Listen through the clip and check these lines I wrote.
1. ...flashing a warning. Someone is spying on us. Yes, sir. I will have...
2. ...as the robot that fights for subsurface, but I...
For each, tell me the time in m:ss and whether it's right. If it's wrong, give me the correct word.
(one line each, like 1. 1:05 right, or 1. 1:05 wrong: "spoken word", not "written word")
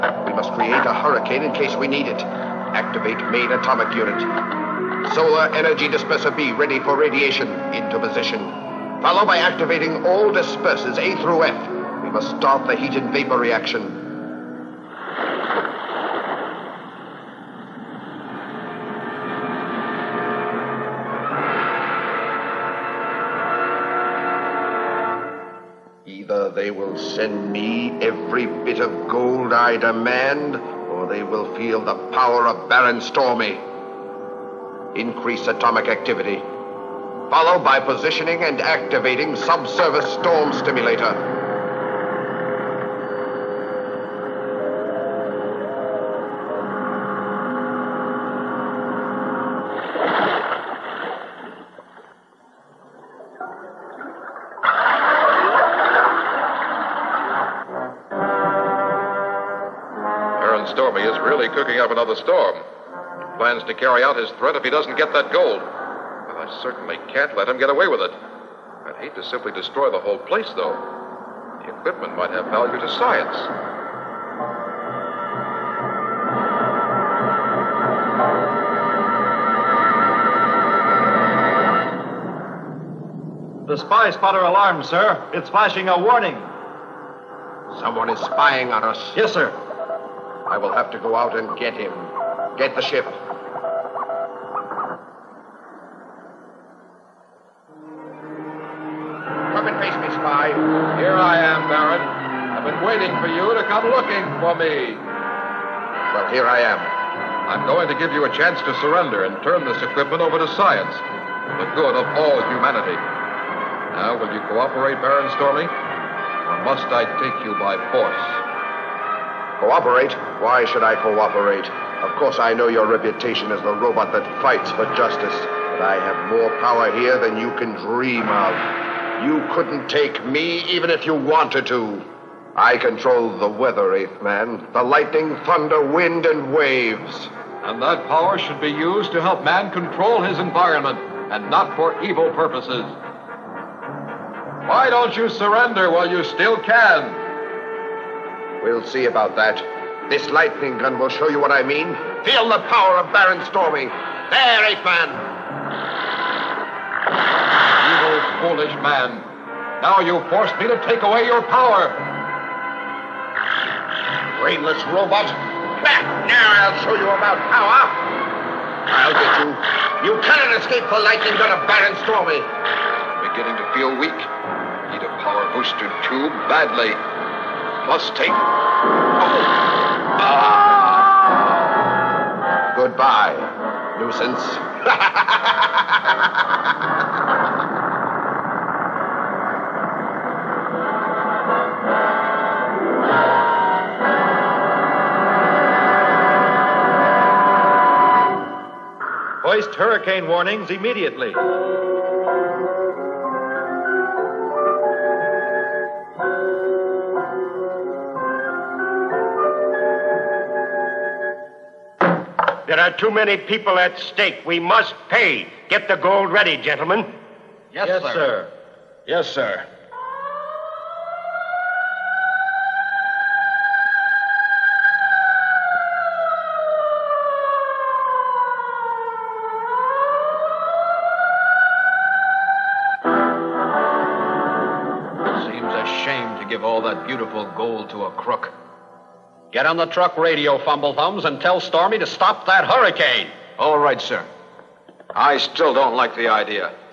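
1. 1:25 right
2. 2:03 wrong: "justice", not "subsurface".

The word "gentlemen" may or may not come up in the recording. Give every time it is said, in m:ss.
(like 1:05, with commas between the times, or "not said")
3:36.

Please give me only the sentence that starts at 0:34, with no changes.
Increase atomic activity, followed by positioning and activating subsurface storm stimulator.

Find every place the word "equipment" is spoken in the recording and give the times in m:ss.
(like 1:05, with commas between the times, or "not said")
1:11, 1:49.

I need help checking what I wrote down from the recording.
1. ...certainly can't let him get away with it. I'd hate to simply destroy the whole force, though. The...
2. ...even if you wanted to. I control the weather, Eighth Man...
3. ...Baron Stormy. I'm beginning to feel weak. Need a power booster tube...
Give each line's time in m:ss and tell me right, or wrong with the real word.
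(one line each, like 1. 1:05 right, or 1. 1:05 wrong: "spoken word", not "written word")
1. 1:06 wrong: "place", not "force"
2. 2:10 right
3. 2:51 right.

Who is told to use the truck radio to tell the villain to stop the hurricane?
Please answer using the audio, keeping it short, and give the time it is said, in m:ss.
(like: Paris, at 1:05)
Fumblethumbs, at 4:00.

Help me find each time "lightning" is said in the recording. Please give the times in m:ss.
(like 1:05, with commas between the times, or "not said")
2:14, 2:30, 2:51.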